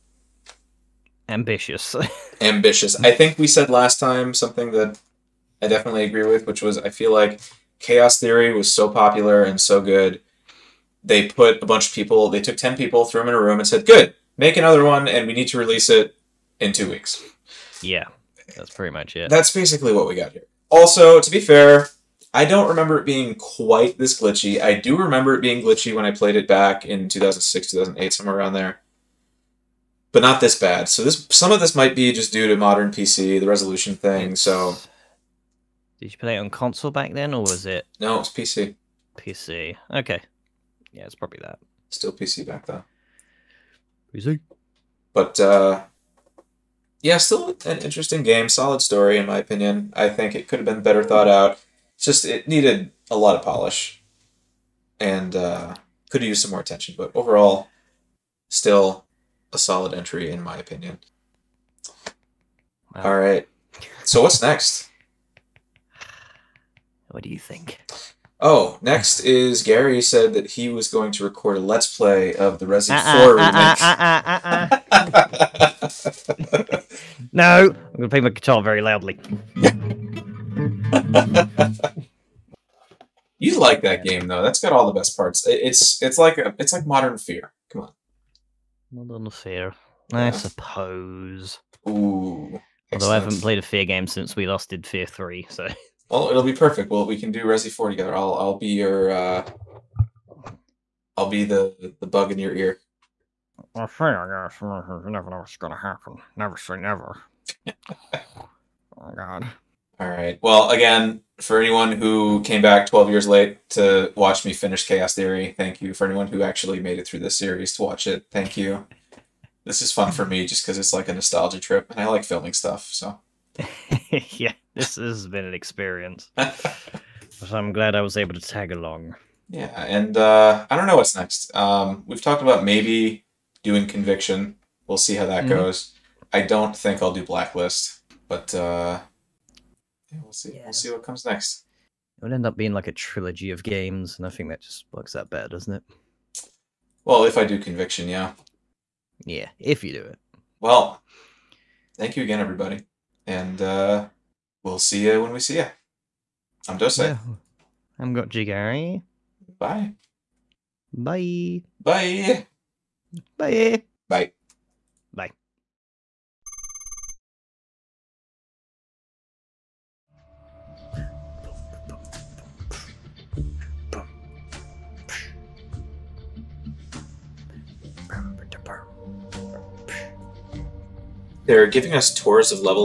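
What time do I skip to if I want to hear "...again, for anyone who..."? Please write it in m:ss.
1:50.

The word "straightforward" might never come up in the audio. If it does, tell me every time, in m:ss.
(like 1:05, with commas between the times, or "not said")
not said.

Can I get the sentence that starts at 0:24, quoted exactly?
I do remember it being glitchy when I played it back in 2006, 2008, somewhere around there.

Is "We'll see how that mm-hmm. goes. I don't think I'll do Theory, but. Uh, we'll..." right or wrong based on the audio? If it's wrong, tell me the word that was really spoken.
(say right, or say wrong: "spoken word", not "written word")
wrong: "Blacklist", not "Theory".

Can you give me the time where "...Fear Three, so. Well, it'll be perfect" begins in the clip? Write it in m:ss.
1:34.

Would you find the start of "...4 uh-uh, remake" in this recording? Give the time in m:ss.
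1:13.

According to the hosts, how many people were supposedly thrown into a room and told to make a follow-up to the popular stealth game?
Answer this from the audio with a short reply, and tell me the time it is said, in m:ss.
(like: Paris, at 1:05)
10, at 0:12.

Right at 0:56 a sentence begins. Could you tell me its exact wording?
But overall, still a solid entry in my opinion.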